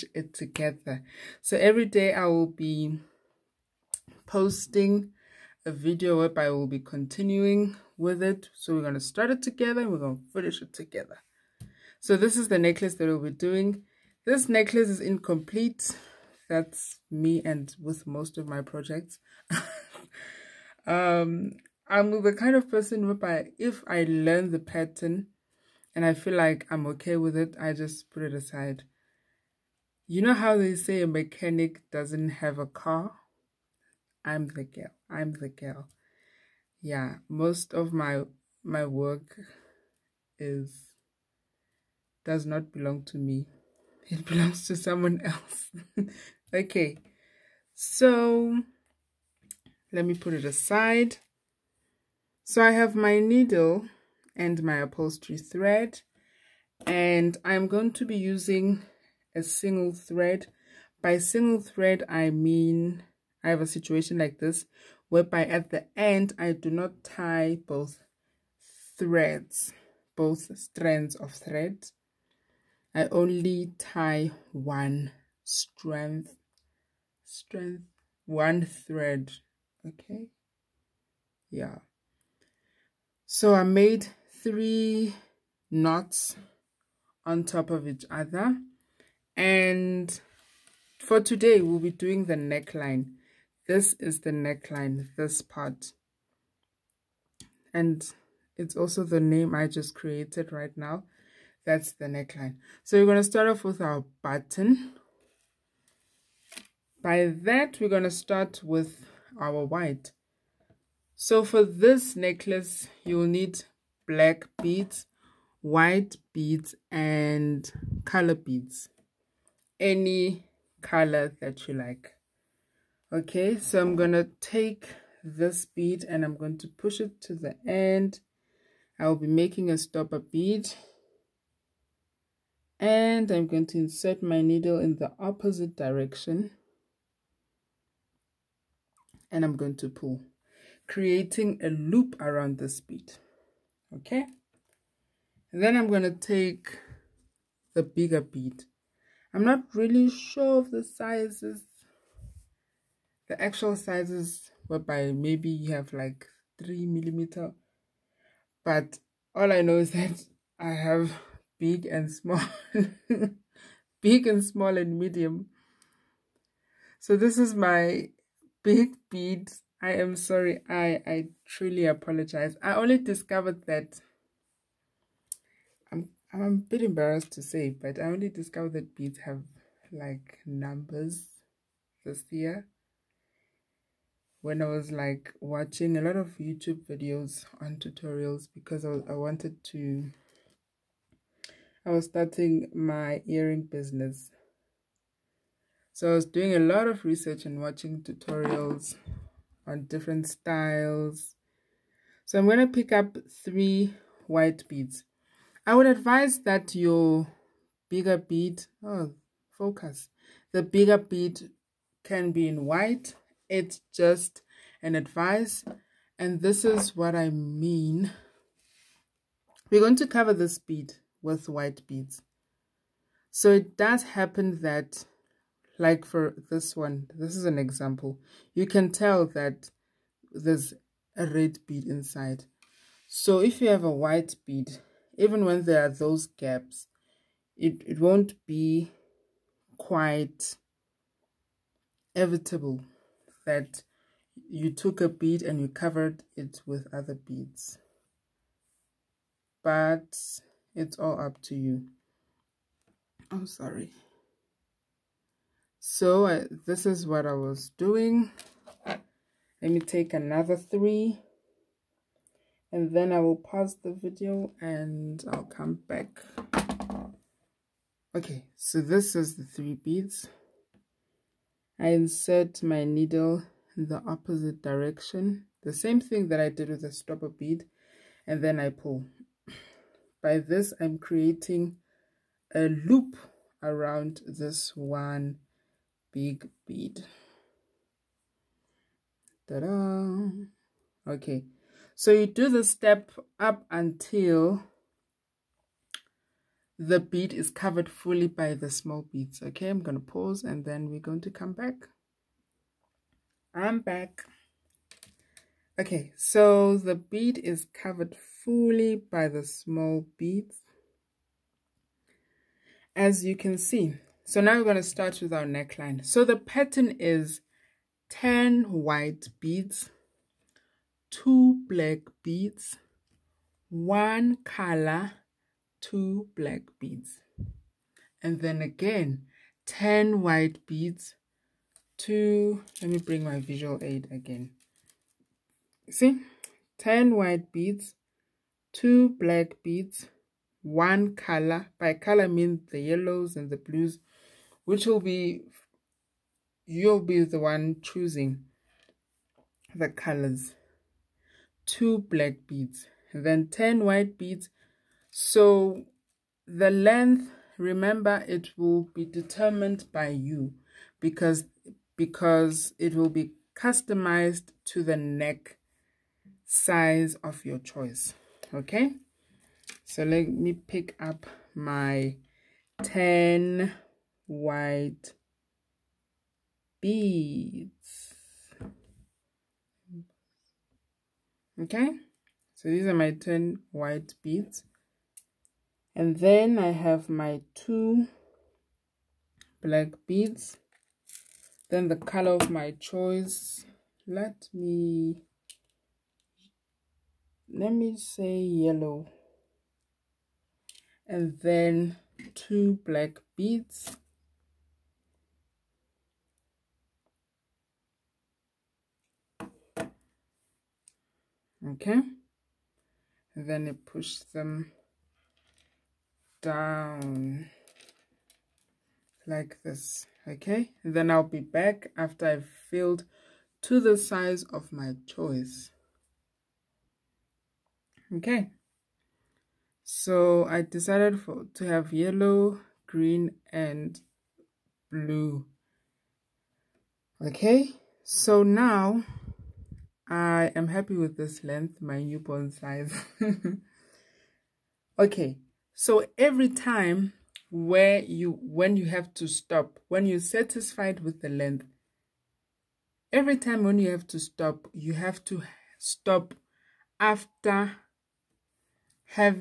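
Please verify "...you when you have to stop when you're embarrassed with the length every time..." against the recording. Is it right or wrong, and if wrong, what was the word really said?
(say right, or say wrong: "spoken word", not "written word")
wrong: "satisfied", not "embarrassed".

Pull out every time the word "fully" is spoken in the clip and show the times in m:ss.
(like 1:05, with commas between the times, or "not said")
4:57, 5:08.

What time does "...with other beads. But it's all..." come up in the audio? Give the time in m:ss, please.
4:06.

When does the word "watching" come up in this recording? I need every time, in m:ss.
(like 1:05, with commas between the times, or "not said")
3:05, 3:17.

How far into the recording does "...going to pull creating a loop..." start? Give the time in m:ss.
2:19.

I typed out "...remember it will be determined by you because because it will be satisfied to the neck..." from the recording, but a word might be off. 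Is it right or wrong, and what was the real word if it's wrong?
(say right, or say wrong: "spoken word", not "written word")
wrong: "customized", not "satisfied".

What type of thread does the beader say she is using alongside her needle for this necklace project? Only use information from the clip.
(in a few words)
upholstery thread.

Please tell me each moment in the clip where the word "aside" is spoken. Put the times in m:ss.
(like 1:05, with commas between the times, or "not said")
0:28, 0:50.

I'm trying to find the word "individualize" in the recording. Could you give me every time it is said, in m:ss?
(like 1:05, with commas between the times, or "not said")
not said.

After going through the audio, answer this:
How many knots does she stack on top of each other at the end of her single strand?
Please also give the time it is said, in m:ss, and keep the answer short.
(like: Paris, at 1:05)
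3, at 1:24.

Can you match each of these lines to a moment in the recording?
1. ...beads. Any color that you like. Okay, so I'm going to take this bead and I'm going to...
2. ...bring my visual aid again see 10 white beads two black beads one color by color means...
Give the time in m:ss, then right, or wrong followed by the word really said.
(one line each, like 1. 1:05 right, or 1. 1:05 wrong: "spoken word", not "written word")
1. 1:58 right
2. 5:32 right.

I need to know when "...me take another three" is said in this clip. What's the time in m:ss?
4:19.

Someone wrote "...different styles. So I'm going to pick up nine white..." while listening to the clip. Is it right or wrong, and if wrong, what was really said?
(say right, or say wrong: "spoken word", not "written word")
wrong: "three", not "nine".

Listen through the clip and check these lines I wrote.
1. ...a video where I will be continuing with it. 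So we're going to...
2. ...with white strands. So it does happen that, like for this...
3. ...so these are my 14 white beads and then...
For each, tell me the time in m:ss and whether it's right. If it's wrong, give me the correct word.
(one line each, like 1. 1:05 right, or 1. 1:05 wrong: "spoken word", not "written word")
1. 0:05 right
2. 3:41 wrong: "beads", not "strands"
3. 6:22 wrong: "10", not "14".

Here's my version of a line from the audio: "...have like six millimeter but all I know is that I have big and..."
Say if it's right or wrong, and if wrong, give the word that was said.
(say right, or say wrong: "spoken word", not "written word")
wrong: "three", not "six".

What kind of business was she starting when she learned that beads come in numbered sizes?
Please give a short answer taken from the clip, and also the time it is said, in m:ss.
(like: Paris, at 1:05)
earring business, at 3:13.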